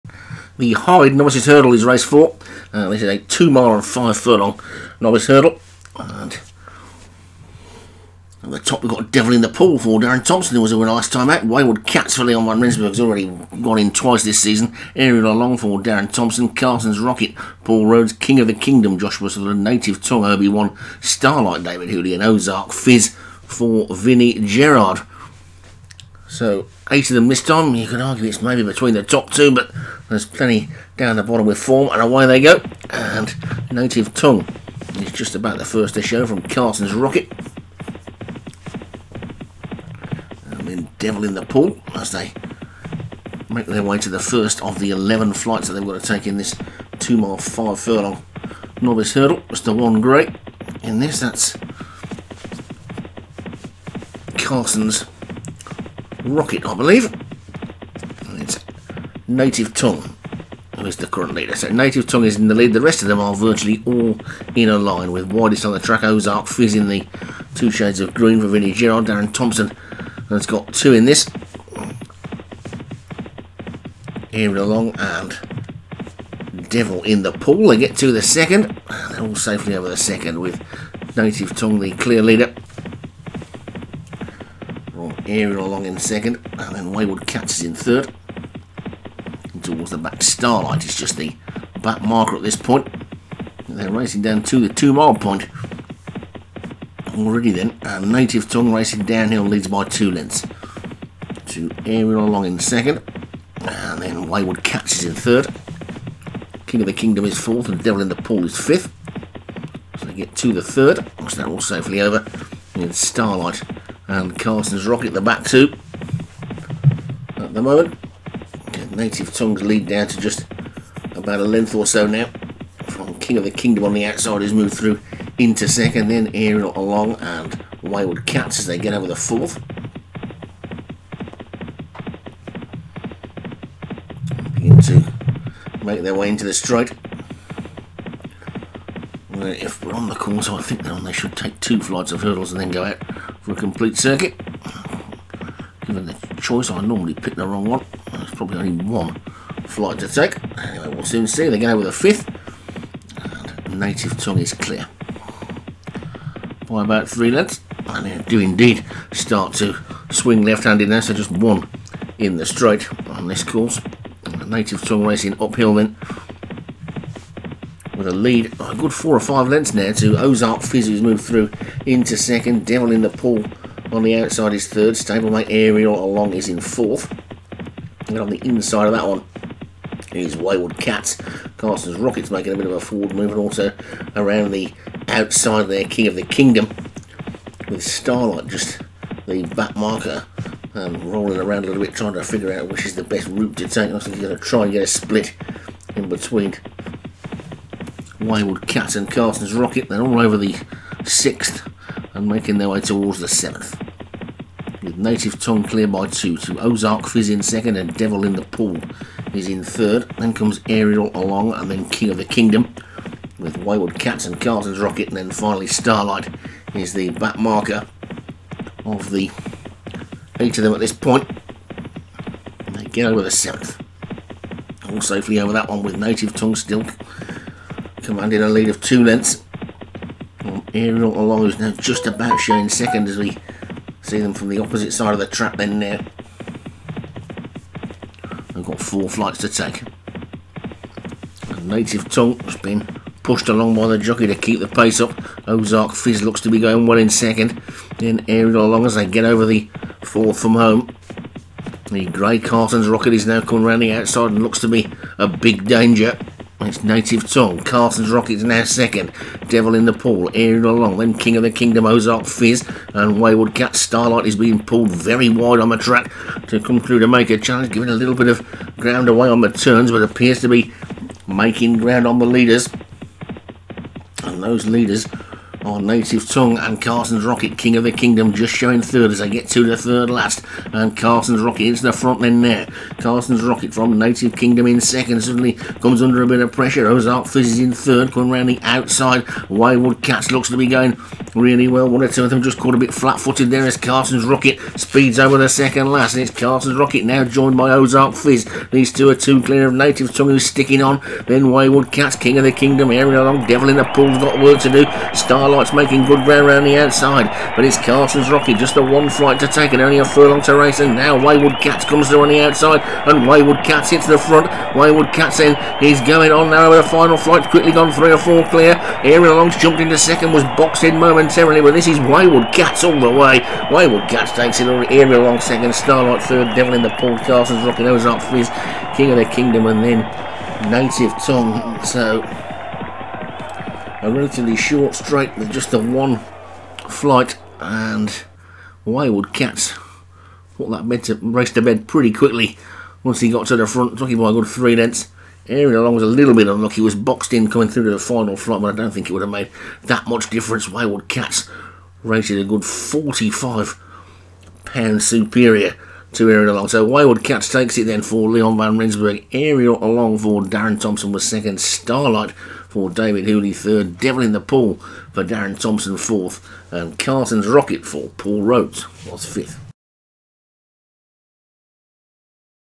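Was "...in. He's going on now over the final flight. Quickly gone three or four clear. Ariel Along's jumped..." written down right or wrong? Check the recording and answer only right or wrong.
right.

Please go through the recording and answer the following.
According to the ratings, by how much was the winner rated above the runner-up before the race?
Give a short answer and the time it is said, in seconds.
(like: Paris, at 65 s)
£45, at 352 s.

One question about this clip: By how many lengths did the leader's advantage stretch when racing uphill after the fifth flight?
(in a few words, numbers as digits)
4 or 5 lengths.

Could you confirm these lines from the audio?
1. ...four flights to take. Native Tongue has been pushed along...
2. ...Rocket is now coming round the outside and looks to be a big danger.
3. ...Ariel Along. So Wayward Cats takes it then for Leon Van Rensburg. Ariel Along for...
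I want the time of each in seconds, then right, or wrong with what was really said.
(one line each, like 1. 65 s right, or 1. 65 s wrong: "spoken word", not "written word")
1. 238 s right
2. 252 s right
3. 356 s right.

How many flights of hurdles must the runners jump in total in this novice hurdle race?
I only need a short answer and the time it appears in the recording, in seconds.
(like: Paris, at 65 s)
11, at 44 s.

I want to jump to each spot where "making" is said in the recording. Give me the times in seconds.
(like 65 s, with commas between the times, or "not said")
182 s, 202 s, 271 s, 305 s.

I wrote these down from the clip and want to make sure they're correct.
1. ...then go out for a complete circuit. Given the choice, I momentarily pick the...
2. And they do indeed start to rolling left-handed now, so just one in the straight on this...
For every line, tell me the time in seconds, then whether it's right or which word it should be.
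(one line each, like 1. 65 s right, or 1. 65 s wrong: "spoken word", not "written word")
1. 142 s wrong: "normally", not "momentarily"
2. 157 s wrong: "swing", not "rolling".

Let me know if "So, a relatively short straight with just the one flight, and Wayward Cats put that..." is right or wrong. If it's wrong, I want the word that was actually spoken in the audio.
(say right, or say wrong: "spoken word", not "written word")
right.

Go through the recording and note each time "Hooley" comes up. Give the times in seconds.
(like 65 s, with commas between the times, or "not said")
21 s, 363 s.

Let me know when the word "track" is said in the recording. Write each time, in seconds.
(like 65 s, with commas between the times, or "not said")
65 s, 235 s, 265 s.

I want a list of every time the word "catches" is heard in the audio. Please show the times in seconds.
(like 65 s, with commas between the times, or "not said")
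87 s, 104 s.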